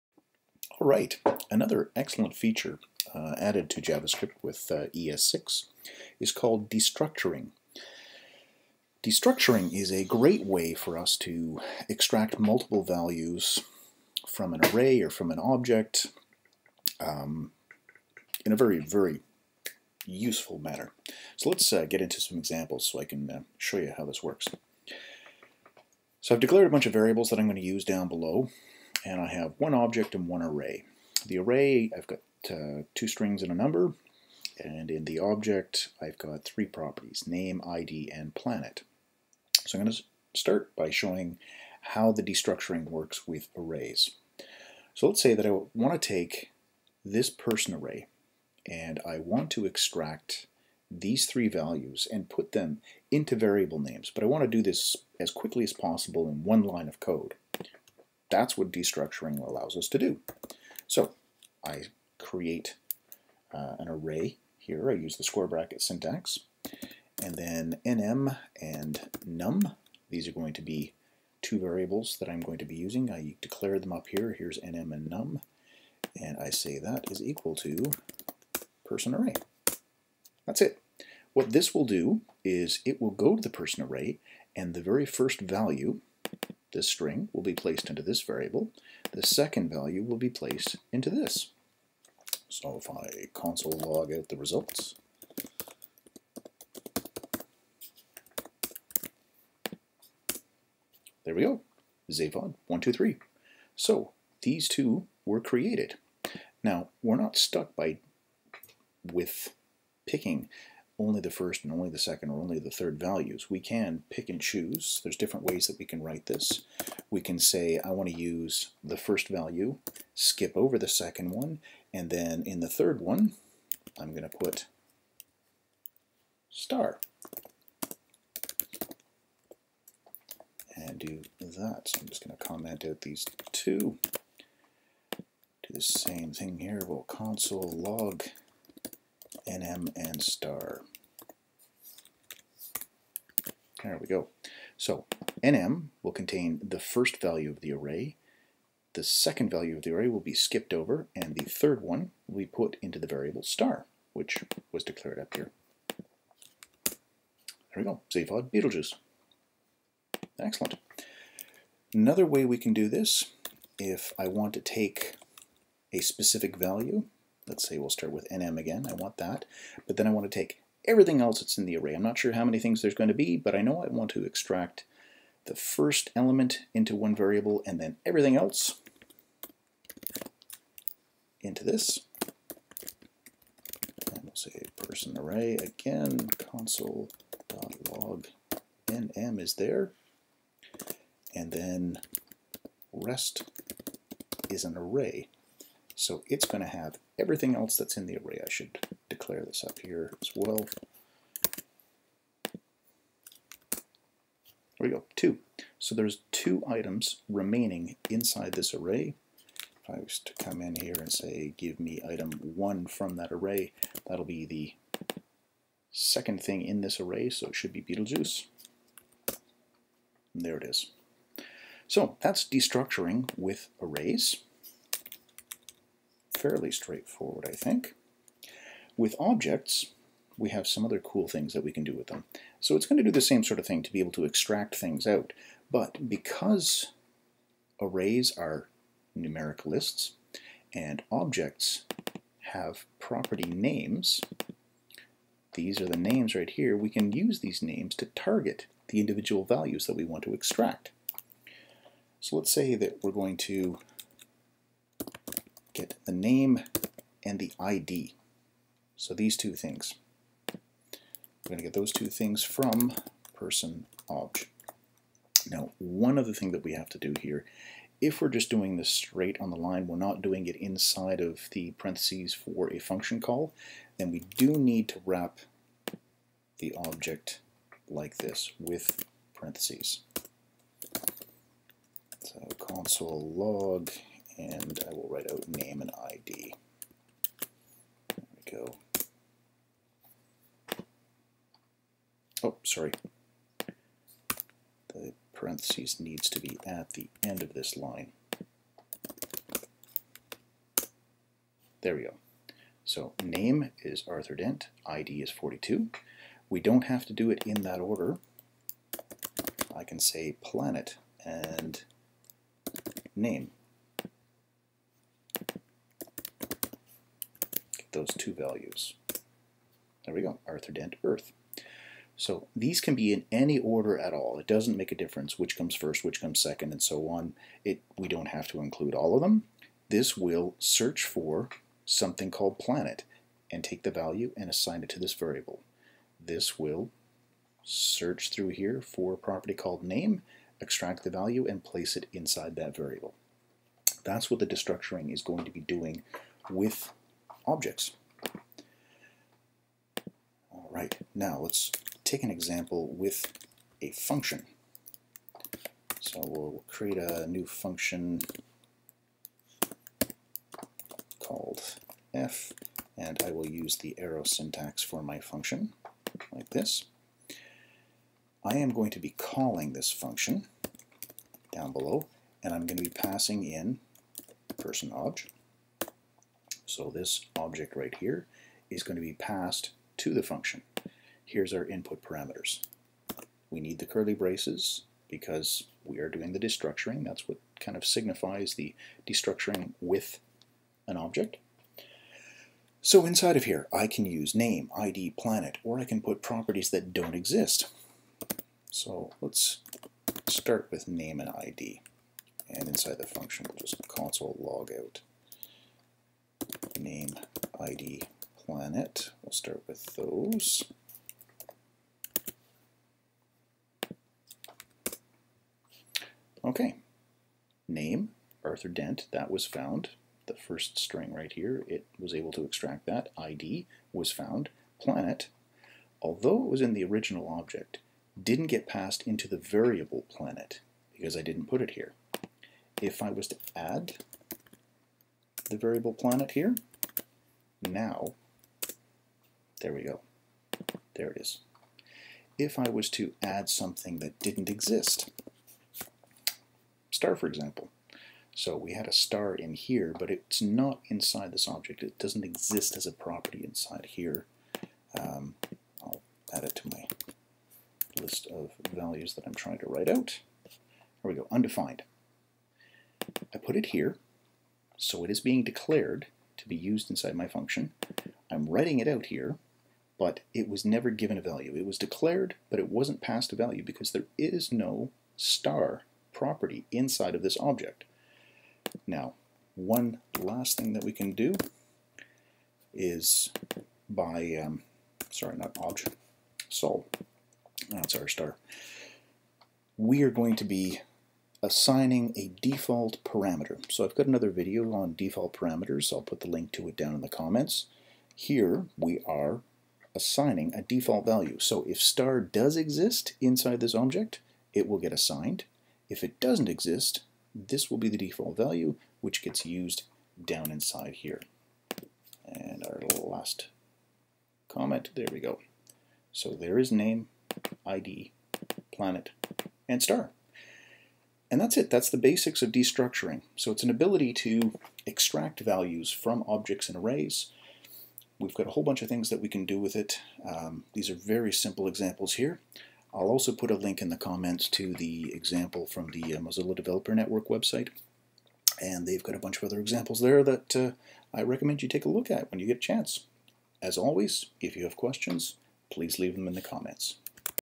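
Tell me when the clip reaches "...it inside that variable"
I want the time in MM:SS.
05:41.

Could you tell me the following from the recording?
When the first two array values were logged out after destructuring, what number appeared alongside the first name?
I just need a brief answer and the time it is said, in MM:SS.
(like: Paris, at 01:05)
123, at 01:42.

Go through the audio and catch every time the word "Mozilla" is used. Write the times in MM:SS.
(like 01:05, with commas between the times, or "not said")
08:56.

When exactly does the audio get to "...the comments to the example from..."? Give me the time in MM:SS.
08:53.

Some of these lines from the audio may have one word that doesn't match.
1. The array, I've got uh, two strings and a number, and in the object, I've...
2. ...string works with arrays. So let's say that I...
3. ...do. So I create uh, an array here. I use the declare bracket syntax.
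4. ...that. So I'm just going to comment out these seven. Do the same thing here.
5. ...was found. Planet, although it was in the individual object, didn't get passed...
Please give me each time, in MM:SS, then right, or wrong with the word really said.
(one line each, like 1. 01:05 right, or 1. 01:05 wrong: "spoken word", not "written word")
1. 00:31 right
2. 00:42 wrong: "destructuring", not "string"
3. 00:59 wrong: "square", not "declare"
4. 02:11 wrong: "two", not "seven"
5. 07:03 wrong: "original", not "individual".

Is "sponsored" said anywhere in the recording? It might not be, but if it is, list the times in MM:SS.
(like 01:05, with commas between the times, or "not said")
not said.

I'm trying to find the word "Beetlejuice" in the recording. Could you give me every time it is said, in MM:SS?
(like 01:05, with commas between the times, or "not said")
02:38, 03:37.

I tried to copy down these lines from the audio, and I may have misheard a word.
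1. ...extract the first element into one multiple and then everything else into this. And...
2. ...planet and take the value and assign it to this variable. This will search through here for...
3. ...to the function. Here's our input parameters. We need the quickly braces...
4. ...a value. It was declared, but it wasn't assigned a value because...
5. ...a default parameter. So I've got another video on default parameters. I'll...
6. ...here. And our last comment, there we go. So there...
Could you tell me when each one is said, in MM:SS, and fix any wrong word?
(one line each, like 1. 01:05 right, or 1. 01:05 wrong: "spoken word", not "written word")
1. 02:54 wrong: "variable", not "multiple"
2. 05:32 right
3. 06:19 wrong: "curly", not "quickly"
4. 07:51 wrong: "passed", not "assigned"
5. 08:12 right
6. 08:30 right.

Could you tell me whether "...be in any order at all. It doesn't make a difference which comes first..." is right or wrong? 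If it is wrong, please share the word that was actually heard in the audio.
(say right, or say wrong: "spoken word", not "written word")
right.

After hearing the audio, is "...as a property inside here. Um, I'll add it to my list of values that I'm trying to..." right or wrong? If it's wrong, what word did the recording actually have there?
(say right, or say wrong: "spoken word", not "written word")
right.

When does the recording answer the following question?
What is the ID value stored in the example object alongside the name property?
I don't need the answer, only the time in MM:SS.
05:05.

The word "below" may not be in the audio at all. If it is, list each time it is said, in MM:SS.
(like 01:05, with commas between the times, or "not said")
00:28, 06:11.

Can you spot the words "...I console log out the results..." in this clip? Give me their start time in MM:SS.
01:32.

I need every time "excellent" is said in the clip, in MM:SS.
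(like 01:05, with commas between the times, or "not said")
00:01, 02:40.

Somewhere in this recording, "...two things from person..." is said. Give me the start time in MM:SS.
04:21.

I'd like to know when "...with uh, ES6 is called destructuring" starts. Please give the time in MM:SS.
00:04.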